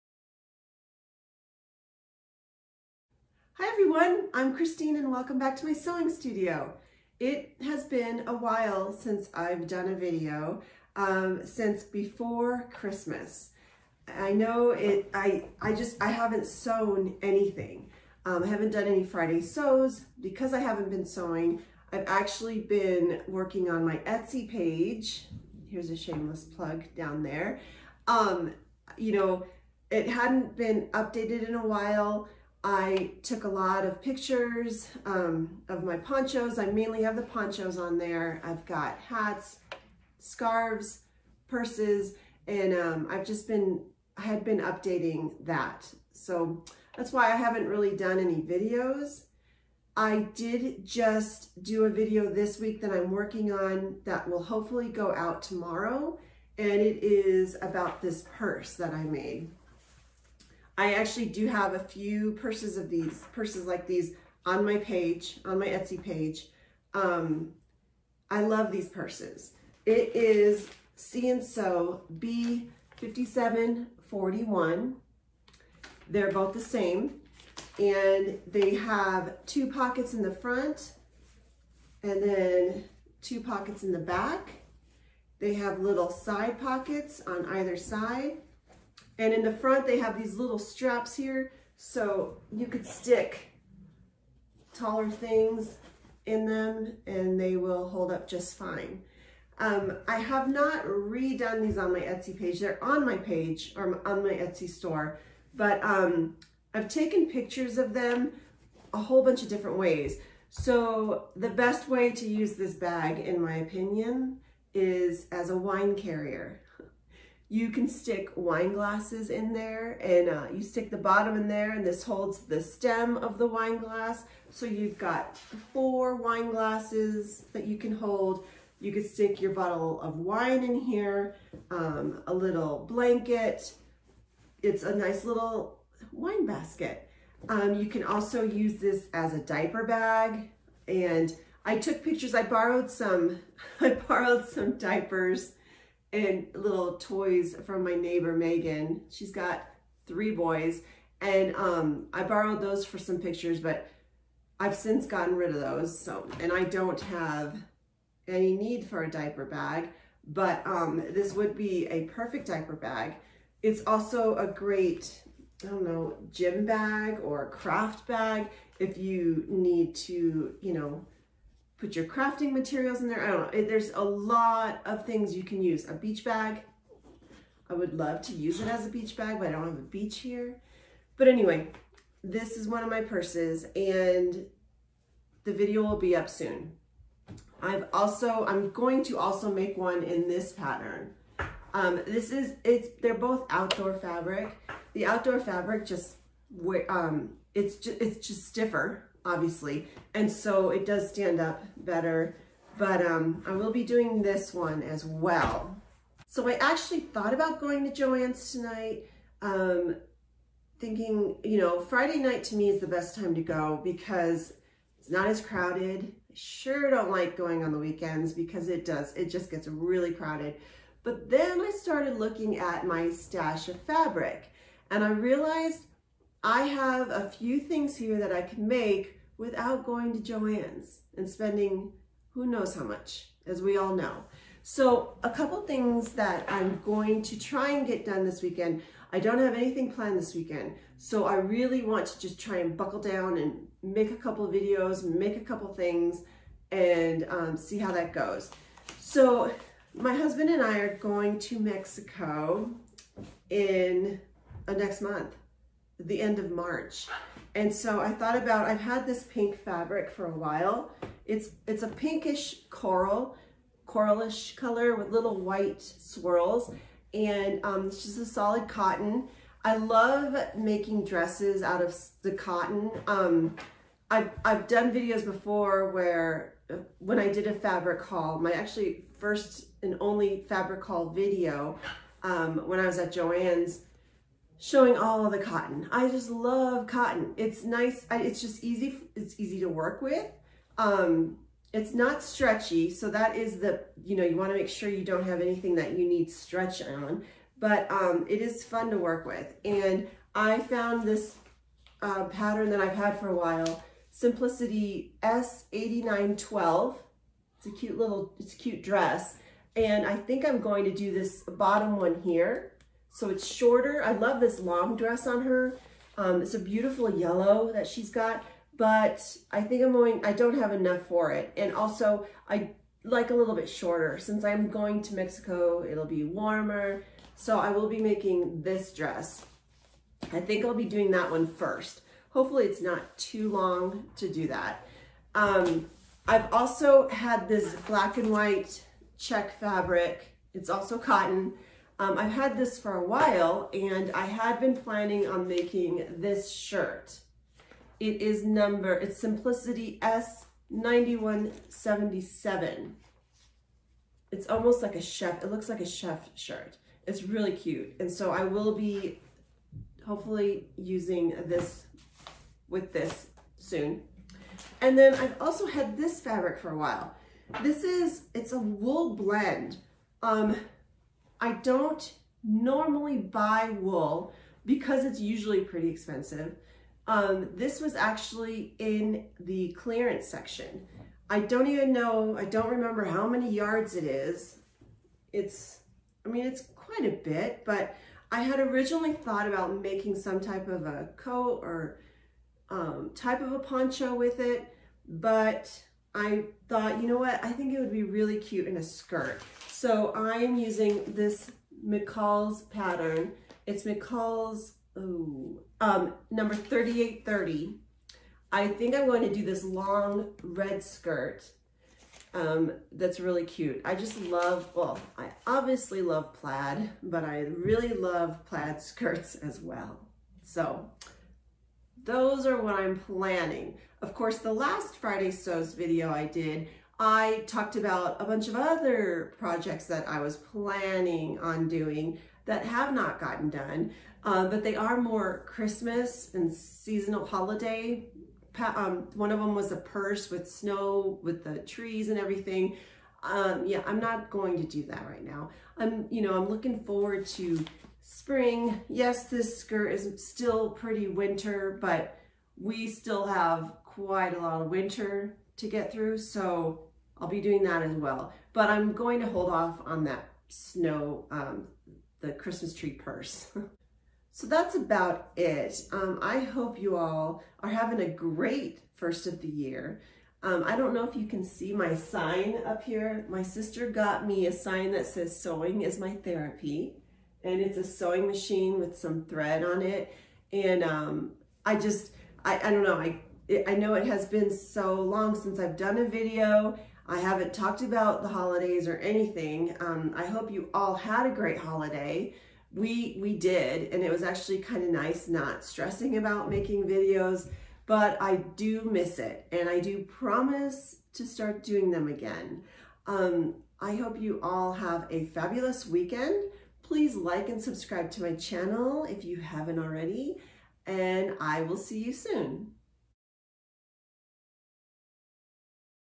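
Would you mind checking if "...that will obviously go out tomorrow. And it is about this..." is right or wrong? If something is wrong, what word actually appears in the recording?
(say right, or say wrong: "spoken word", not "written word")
wrong: "hopefully", not "obviously".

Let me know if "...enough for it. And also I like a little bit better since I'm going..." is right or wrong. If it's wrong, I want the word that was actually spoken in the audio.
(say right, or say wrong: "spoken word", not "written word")
wrong: "shorter", not "better".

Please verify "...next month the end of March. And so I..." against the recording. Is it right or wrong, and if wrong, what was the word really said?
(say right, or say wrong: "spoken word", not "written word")
right.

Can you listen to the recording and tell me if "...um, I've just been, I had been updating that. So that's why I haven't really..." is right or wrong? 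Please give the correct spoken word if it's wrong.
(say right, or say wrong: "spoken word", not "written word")
right.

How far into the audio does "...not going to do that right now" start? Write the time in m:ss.
7:23.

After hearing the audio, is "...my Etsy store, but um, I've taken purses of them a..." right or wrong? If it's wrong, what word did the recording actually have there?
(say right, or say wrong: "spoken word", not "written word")
wrong: "pictures", not "purses".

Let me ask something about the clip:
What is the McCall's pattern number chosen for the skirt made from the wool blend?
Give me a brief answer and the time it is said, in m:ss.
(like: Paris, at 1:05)
3830, at 6:46.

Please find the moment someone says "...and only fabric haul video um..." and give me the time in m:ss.
4:39.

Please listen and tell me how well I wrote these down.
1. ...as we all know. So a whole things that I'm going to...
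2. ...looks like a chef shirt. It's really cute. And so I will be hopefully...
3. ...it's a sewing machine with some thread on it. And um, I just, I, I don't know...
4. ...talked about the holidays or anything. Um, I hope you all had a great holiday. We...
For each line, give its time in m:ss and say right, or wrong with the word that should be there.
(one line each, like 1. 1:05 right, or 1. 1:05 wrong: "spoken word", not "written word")
1. 3:53 wrong: "couple", not "whole"
2. 5:55 right
3. 7:57 right
4. 8:07 right.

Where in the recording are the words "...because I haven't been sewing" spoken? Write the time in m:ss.
0:20.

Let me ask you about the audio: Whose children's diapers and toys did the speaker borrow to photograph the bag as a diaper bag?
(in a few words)
Megan.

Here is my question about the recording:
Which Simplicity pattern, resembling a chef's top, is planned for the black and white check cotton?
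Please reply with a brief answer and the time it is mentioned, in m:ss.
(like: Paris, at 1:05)
S9177, at 5:50.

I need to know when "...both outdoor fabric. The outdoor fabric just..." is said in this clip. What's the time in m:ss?
3:13.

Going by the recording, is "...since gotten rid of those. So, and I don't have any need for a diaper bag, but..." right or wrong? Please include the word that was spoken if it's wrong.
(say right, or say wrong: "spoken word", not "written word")
right.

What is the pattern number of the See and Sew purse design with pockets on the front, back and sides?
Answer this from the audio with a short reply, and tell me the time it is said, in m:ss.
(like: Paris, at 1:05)
B5741, at 1:12.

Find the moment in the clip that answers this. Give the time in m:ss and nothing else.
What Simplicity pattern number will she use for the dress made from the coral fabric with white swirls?
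5:05.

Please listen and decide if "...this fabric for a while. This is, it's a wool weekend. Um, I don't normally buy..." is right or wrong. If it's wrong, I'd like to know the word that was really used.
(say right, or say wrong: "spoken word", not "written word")
wrong: "blend", not "weekend".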